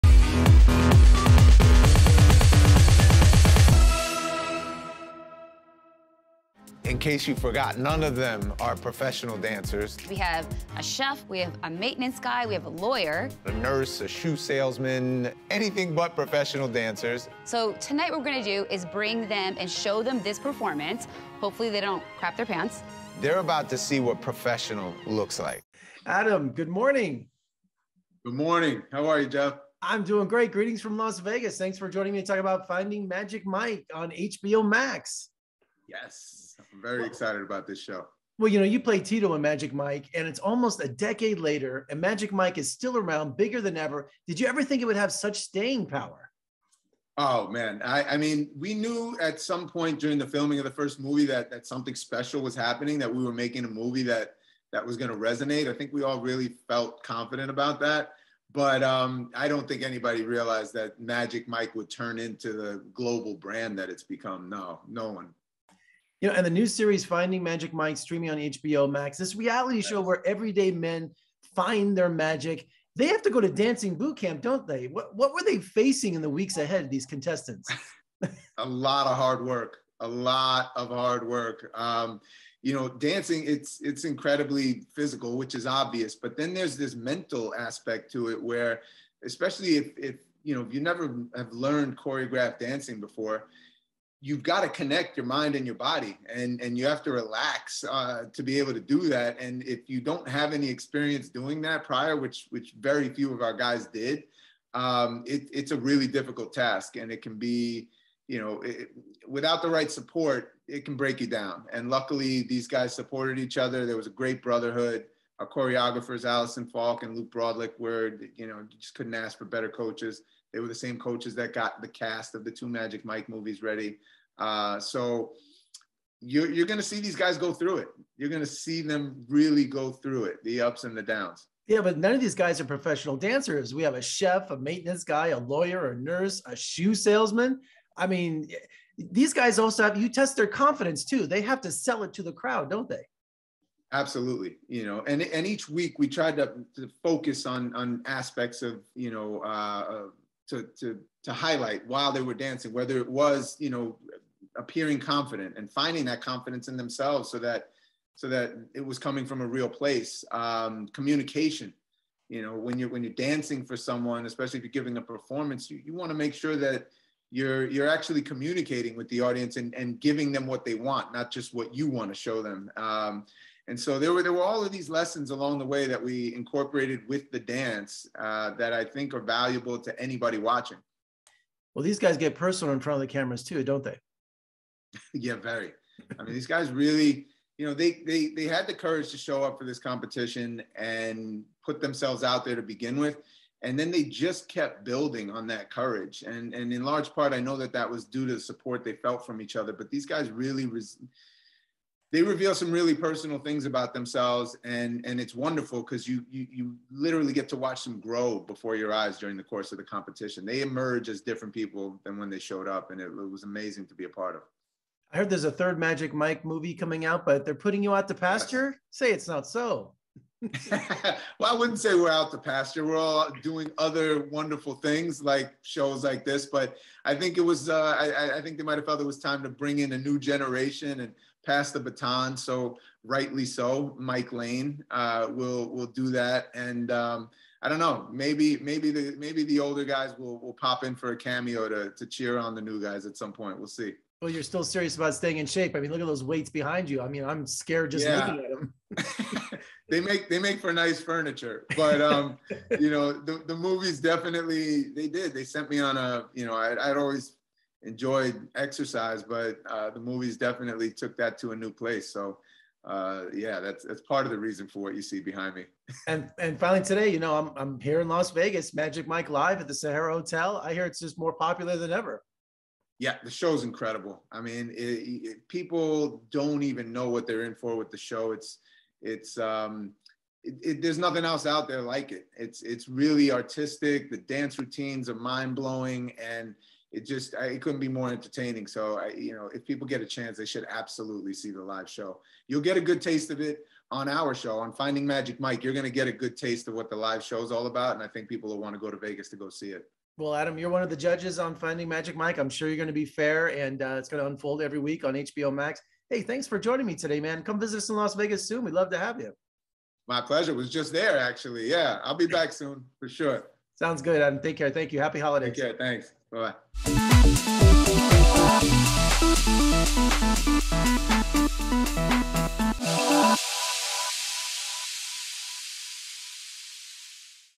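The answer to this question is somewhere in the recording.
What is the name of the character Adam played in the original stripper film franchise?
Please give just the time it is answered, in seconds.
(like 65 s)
38 s.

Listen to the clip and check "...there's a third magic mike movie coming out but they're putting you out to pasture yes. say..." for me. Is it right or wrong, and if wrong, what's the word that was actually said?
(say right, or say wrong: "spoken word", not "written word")
right.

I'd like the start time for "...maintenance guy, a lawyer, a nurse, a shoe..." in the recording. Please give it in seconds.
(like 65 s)
134 s.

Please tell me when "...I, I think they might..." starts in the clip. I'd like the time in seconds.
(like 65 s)
227 s.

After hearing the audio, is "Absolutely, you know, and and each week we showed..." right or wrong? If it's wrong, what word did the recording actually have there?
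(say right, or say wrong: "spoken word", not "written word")
wrong: "tried", not "showed".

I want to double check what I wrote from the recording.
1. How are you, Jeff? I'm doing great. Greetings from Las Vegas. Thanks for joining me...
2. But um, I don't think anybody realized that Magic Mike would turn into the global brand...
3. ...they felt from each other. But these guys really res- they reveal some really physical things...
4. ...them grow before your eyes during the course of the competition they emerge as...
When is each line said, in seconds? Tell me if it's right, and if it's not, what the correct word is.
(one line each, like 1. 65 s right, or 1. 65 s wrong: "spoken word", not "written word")
1. 28 s right
2. 58 s right
3. 198 s wrong: "personal", not "physical"
4. 207 s right.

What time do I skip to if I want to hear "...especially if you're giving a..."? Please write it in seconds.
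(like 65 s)
164 s.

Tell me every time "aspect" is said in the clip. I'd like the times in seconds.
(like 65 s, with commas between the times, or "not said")
87 s, 148 s.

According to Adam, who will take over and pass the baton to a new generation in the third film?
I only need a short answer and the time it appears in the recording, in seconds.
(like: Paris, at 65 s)
Mike Lane, at 233 s.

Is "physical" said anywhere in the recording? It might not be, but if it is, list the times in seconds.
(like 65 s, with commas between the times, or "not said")
84 s.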